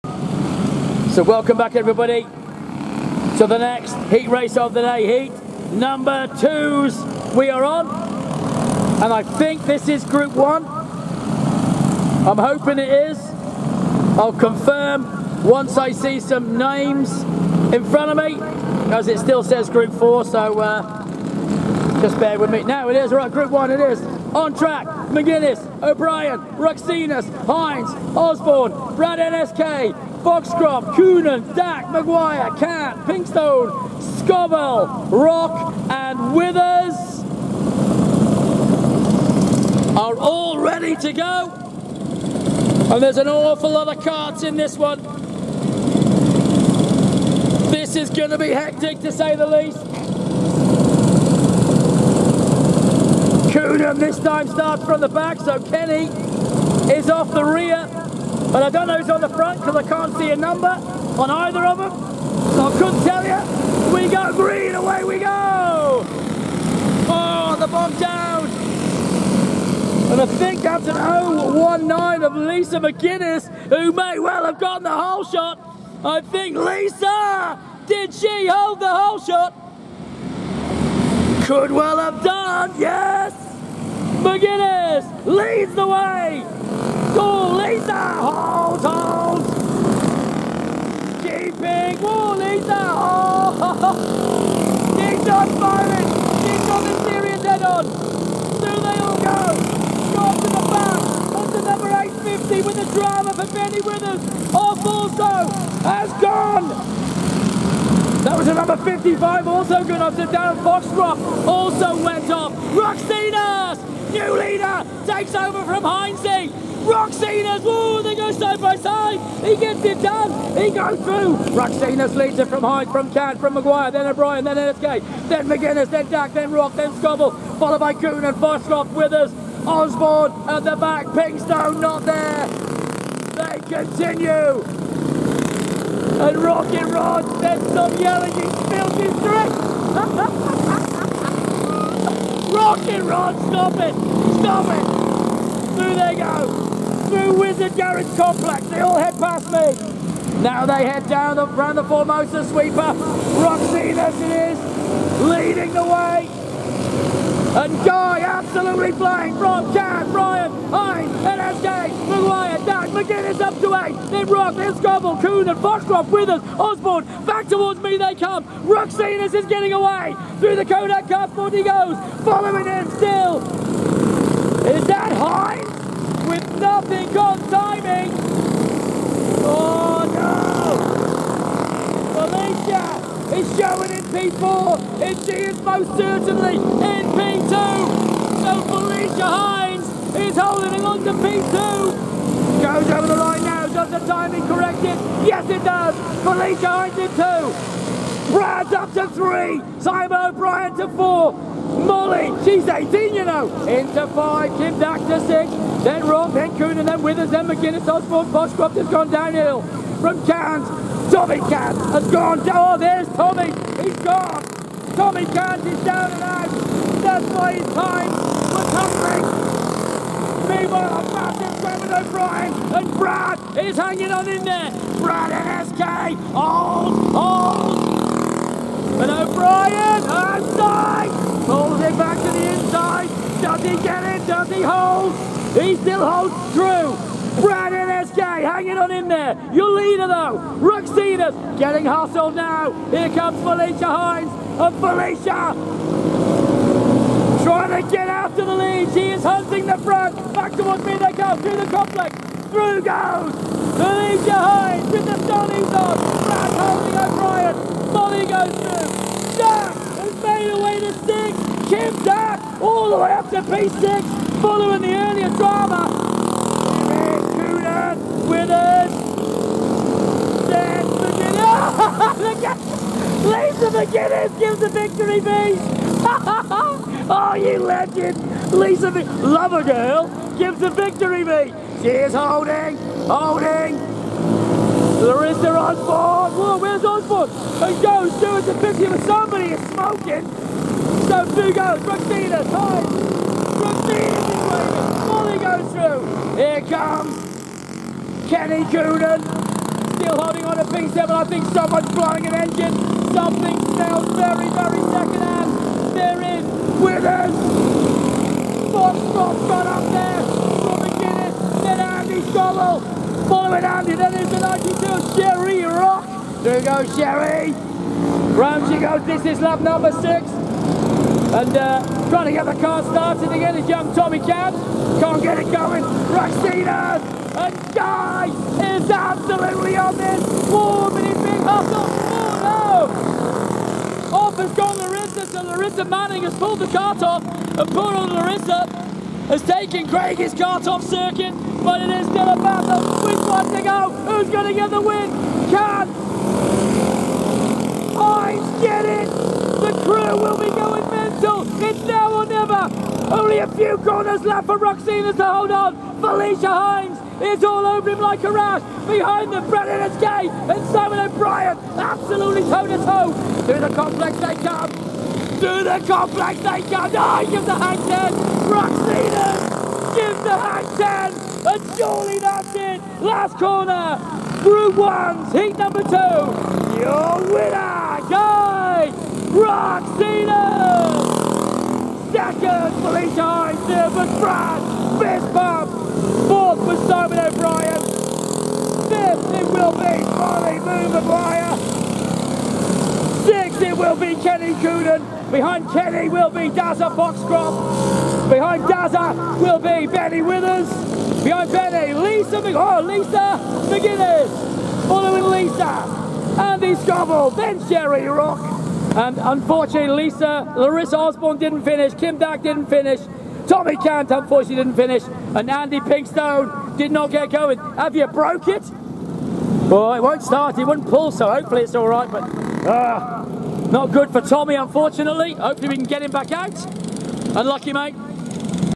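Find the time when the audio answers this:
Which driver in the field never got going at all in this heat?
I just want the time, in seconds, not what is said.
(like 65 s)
415 s.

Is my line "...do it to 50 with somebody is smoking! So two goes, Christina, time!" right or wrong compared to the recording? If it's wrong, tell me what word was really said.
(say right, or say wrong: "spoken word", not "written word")
right.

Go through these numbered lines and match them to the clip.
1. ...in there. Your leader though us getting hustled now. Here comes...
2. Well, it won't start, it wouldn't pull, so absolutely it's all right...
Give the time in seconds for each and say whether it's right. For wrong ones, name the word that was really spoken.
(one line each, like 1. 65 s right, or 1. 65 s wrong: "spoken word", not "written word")
1. 238 s right
2. 419 s wrong: "hopefully", not "absolutely".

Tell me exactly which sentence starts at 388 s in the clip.
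Fifth it will be Molly Moon Maguire!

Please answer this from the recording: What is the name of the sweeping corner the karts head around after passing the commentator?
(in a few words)
Formosa sweeper.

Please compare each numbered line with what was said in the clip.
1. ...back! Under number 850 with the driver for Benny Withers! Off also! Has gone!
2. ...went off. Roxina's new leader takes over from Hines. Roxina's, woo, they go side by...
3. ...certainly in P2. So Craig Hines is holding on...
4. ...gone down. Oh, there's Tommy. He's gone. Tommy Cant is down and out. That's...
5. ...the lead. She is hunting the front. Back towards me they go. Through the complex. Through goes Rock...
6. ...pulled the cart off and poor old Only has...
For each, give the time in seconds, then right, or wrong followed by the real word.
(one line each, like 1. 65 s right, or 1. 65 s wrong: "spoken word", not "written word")
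1. 100 s right
2. 112 s right
3. 185 s wrong: "Felicia", not "Craig"
4. 212 s right
5. 248 s wrong: "Felicia", not "Rock"
6. 336 s wrong: "Larissa", not "Only".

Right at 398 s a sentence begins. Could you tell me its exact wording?
Behind Dazza will be Benny Withers!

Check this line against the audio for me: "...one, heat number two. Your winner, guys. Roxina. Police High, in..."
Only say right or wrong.
right.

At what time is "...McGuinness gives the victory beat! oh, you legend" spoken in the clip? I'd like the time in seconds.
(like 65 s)
273 s.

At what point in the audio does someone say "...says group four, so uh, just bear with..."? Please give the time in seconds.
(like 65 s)
19 s.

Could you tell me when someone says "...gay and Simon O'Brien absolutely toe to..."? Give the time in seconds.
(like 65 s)
359 s.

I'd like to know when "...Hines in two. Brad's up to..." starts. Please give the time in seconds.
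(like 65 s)
196 s.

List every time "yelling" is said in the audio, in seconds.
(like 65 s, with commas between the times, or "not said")
137 s.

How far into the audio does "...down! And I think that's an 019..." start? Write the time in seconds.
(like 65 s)
67 s.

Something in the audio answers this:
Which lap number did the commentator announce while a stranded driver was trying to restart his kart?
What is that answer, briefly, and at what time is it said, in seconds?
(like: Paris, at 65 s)
6, at 319 s.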